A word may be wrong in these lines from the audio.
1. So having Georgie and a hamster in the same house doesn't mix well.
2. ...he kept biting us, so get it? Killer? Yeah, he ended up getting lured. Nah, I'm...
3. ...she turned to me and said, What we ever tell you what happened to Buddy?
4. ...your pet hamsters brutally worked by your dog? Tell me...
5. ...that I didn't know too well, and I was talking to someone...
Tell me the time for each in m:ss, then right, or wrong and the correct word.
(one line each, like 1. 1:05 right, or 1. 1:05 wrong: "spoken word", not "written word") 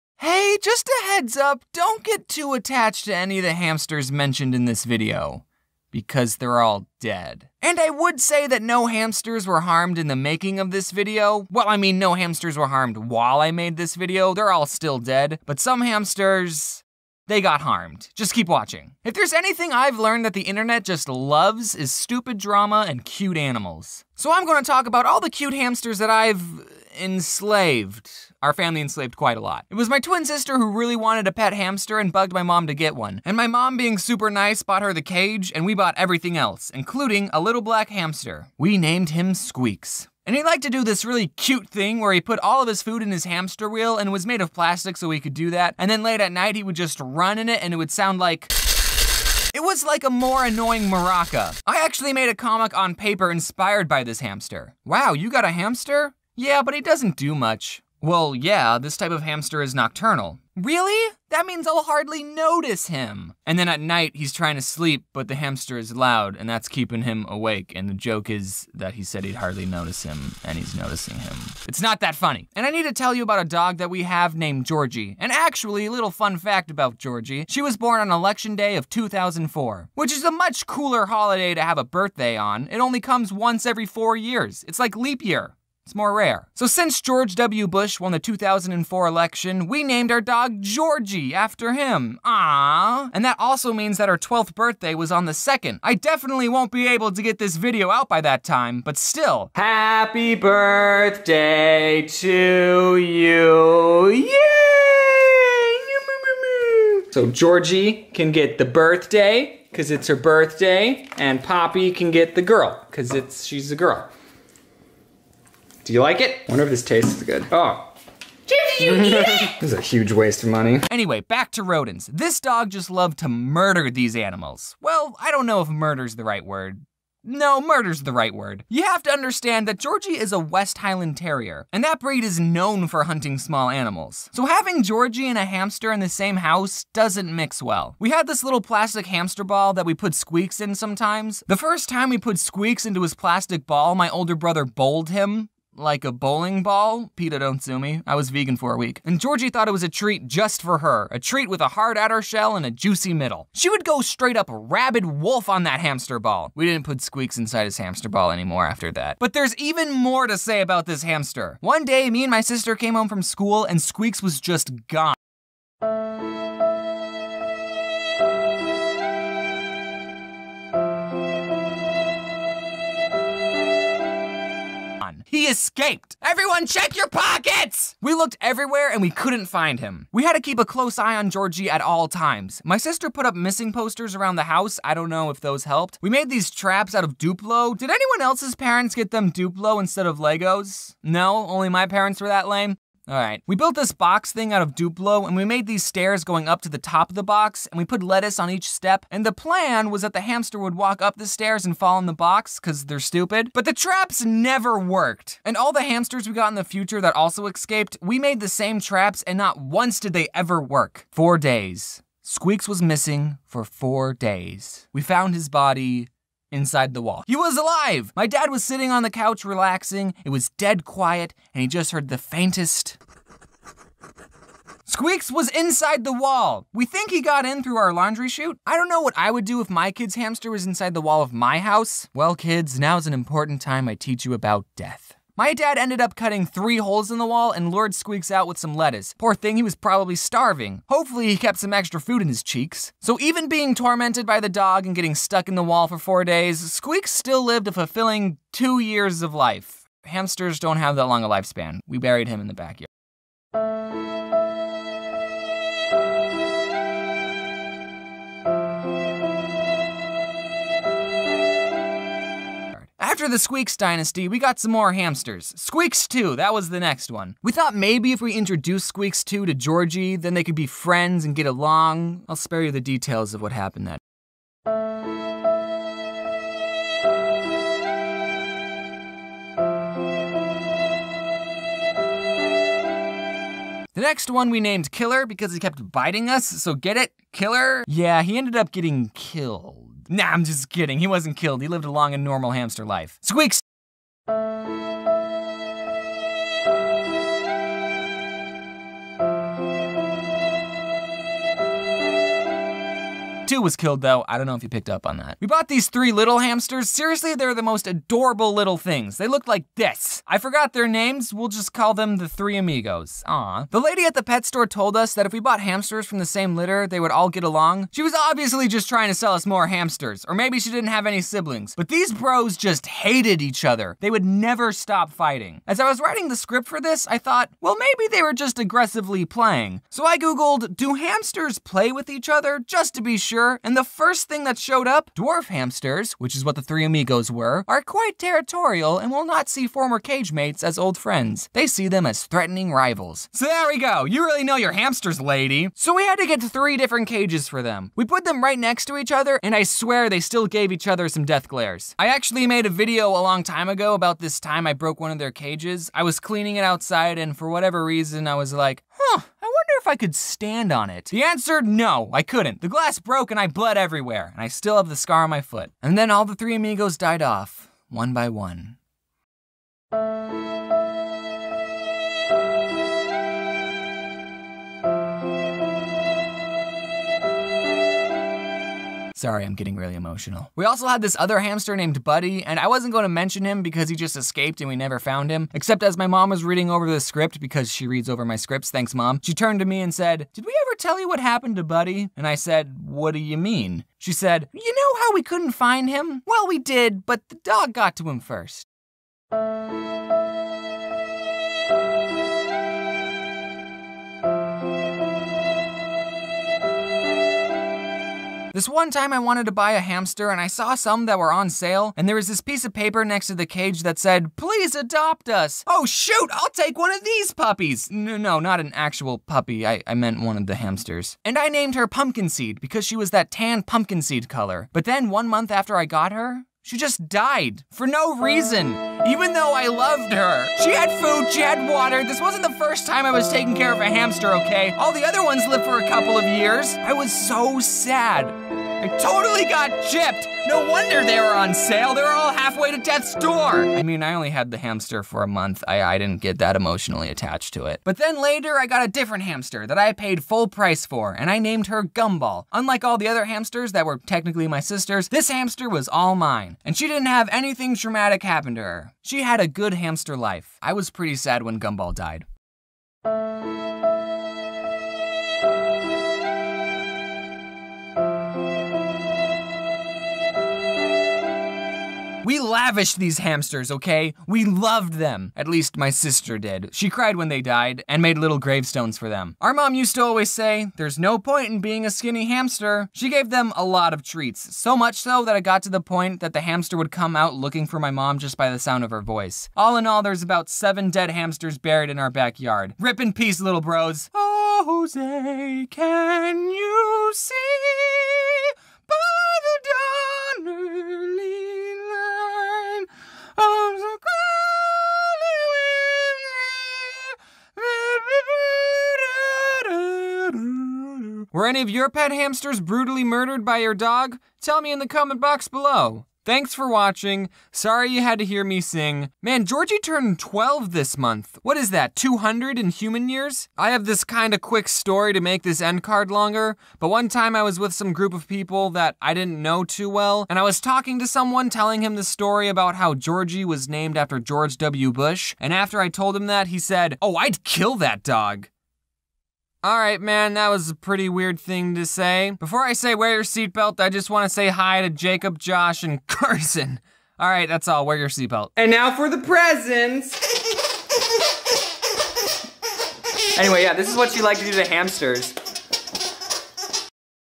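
1. 2:14 right
2. 4:45 wrong: "killed", not "lured"
3. 6:29 wrong: "Did", not "What"
4. 8:31 wrong: "murdered", not "worked"
5. 8:48 right.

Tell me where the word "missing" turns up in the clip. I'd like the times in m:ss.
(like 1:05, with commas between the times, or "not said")
3:03, 3:32.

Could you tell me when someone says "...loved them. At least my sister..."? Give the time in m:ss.
7:54.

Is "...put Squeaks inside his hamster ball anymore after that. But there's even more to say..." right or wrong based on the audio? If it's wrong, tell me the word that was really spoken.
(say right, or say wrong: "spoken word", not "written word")
right.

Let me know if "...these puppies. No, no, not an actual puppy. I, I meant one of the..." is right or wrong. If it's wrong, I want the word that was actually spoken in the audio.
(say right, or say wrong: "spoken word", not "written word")
right.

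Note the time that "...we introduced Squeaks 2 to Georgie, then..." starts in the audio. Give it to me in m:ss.
4:28.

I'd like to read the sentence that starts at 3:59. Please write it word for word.
Poor thing, he was probably starving.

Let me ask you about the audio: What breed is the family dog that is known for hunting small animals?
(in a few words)
West Highland Terrier.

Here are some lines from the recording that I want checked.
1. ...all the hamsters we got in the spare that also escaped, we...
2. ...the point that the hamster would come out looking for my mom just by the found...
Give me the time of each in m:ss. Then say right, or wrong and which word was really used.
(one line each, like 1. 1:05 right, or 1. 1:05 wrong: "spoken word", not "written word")
1. 3:25 wrong: "future", not "spare"
2. 8:05 wrong: "sound", not "found".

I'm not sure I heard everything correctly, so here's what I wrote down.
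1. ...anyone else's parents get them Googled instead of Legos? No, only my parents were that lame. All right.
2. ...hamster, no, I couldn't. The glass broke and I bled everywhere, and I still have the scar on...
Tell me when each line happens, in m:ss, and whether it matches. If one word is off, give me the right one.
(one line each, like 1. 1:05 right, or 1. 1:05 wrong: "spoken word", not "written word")
1. 3:07 wrong: "Duplo", not "Googled"
2. 6:01 wrong: "answer", not "hamster".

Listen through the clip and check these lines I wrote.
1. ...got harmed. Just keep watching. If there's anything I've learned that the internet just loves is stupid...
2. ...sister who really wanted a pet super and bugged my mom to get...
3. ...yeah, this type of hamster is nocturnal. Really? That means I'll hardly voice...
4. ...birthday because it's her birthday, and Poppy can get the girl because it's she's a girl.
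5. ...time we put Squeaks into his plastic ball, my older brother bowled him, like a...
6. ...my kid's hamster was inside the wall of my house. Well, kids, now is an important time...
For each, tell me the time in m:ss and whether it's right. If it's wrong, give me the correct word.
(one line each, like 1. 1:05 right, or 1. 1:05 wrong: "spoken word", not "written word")
1. 0:17 right
2. 0:30 wrong: "hamster", not "super"
3. 0:58 wrong: "notice", not "voice"
4. 1:48 right
5. 2:21 right
6. 3:49 right.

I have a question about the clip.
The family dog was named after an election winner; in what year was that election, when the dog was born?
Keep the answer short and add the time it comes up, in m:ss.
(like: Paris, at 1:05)
2004, at 1:18.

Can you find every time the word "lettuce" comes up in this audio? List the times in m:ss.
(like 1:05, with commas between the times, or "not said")
3:18, 3:58.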